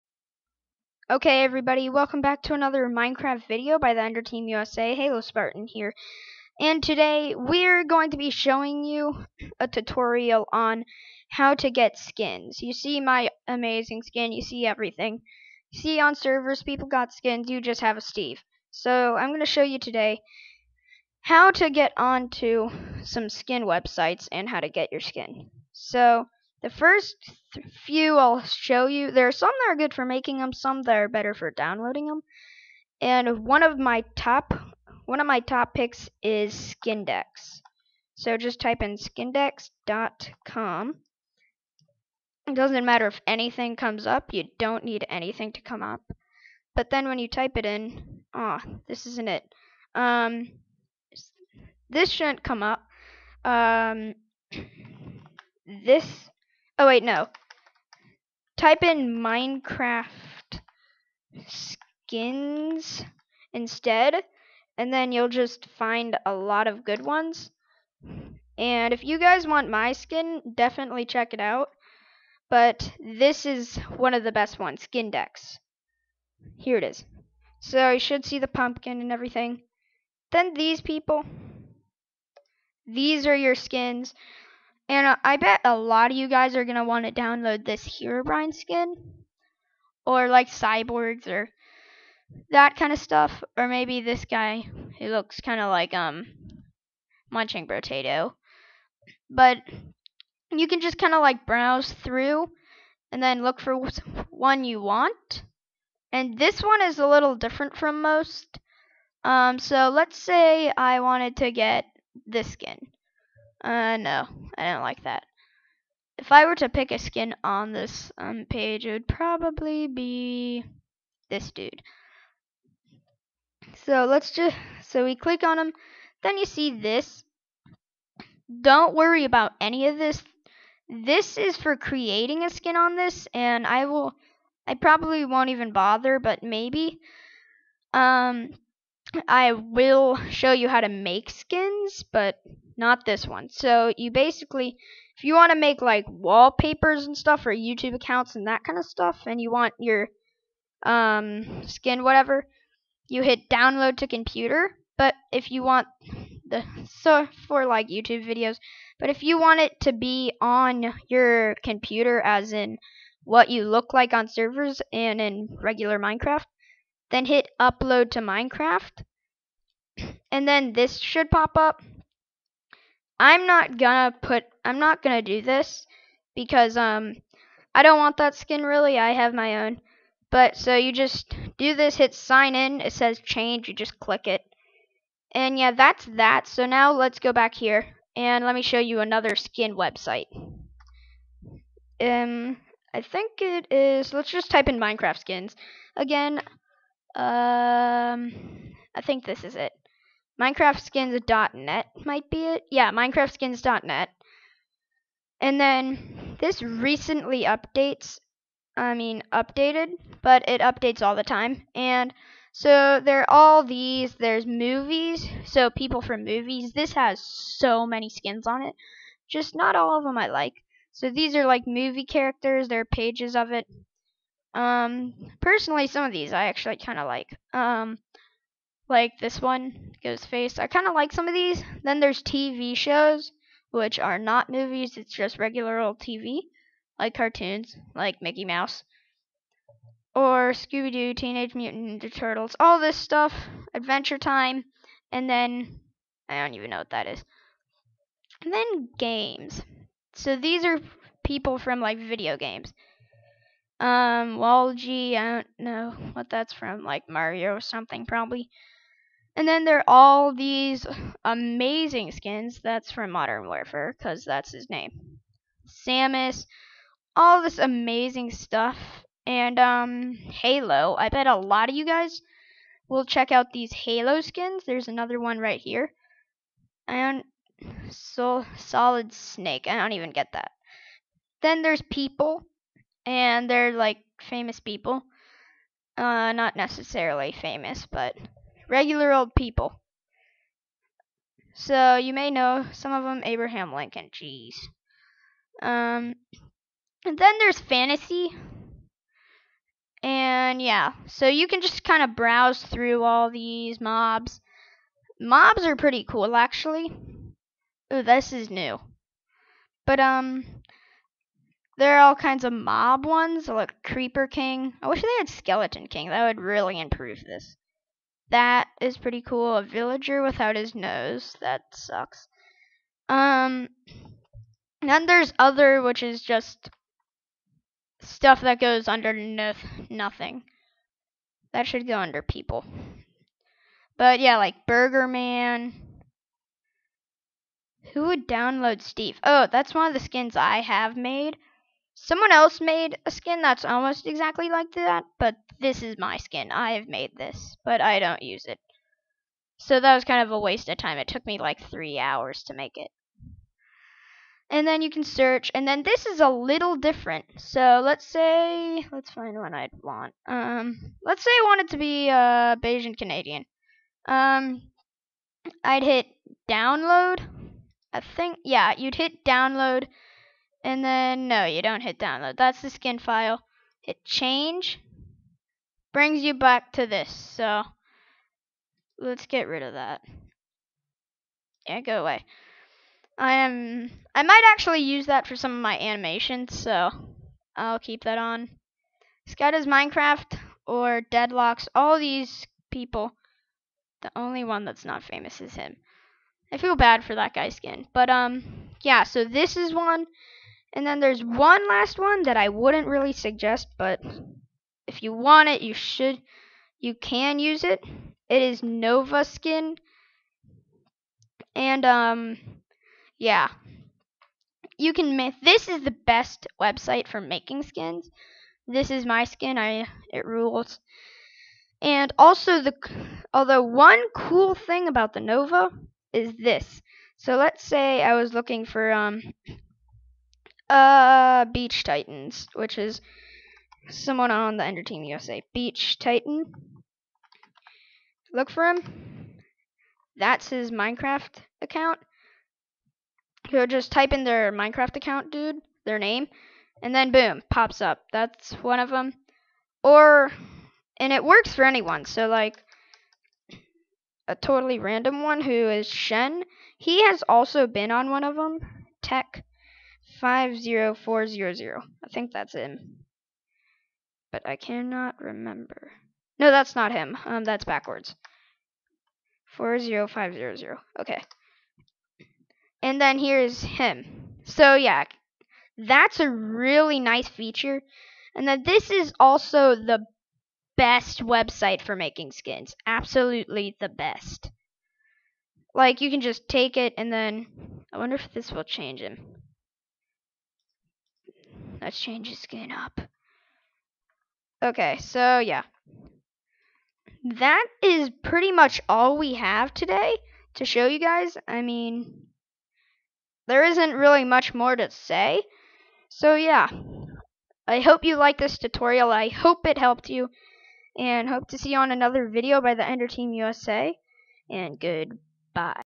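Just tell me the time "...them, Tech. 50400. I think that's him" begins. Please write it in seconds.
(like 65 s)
458 s.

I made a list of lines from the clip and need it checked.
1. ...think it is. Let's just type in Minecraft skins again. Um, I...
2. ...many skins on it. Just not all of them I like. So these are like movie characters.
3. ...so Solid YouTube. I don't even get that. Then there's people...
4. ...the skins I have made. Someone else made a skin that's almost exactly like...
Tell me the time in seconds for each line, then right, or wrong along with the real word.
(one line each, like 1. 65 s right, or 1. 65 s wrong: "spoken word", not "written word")
1. 193 s right
2. 217 s right
3. 277 s wrong: "Snake", not "YouTube"
4. 339 s right.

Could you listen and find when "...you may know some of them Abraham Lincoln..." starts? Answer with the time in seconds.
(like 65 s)
291 s.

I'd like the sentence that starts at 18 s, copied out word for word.
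So, I'm going to show you today how to get onto some skin websites and how to get your skin.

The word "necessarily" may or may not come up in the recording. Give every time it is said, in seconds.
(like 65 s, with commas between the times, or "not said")
286 s.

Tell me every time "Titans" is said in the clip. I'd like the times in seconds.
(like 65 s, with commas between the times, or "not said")
431 s, 435 s.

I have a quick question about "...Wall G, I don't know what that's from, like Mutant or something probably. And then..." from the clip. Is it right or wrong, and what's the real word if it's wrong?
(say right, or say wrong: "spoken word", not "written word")
wrong: "Mario", not "Mutant".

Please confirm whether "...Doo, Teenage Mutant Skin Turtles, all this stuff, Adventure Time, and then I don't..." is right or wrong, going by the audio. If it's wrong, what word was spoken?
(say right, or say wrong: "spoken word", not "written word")
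wrong: "Ninja", not "Skin".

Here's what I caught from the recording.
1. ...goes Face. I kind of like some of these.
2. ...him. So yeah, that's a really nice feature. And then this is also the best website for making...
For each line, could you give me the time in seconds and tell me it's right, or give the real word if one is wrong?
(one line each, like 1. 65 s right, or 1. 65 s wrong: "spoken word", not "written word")
1. 230 s right
2. 473 s right.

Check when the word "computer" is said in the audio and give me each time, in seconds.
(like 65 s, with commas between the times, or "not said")
154 s, 161 s.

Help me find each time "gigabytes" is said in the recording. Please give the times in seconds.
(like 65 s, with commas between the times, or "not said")
not said.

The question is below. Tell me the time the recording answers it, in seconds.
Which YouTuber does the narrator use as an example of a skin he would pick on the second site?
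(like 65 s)
362 s.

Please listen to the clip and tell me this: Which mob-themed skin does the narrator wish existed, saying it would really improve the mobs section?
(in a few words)
Skeleton King.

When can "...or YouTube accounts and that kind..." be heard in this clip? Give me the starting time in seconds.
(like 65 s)
147 s.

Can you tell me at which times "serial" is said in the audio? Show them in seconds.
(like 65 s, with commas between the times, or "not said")
not said.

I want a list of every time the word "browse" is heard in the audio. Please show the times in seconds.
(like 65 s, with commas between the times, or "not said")
101 s, 302 s.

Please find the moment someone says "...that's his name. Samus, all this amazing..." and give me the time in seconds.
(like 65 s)
264 s.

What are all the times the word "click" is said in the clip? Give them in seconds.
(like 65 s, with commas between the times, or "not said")
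125 s, 183 s.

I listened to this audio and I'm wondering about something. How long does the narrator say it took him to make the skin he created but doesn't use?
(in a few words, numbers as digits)
3 hours.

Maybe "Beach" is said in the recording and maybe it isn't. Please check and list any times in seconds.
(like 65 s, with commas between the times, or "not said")
431 s, 435 s.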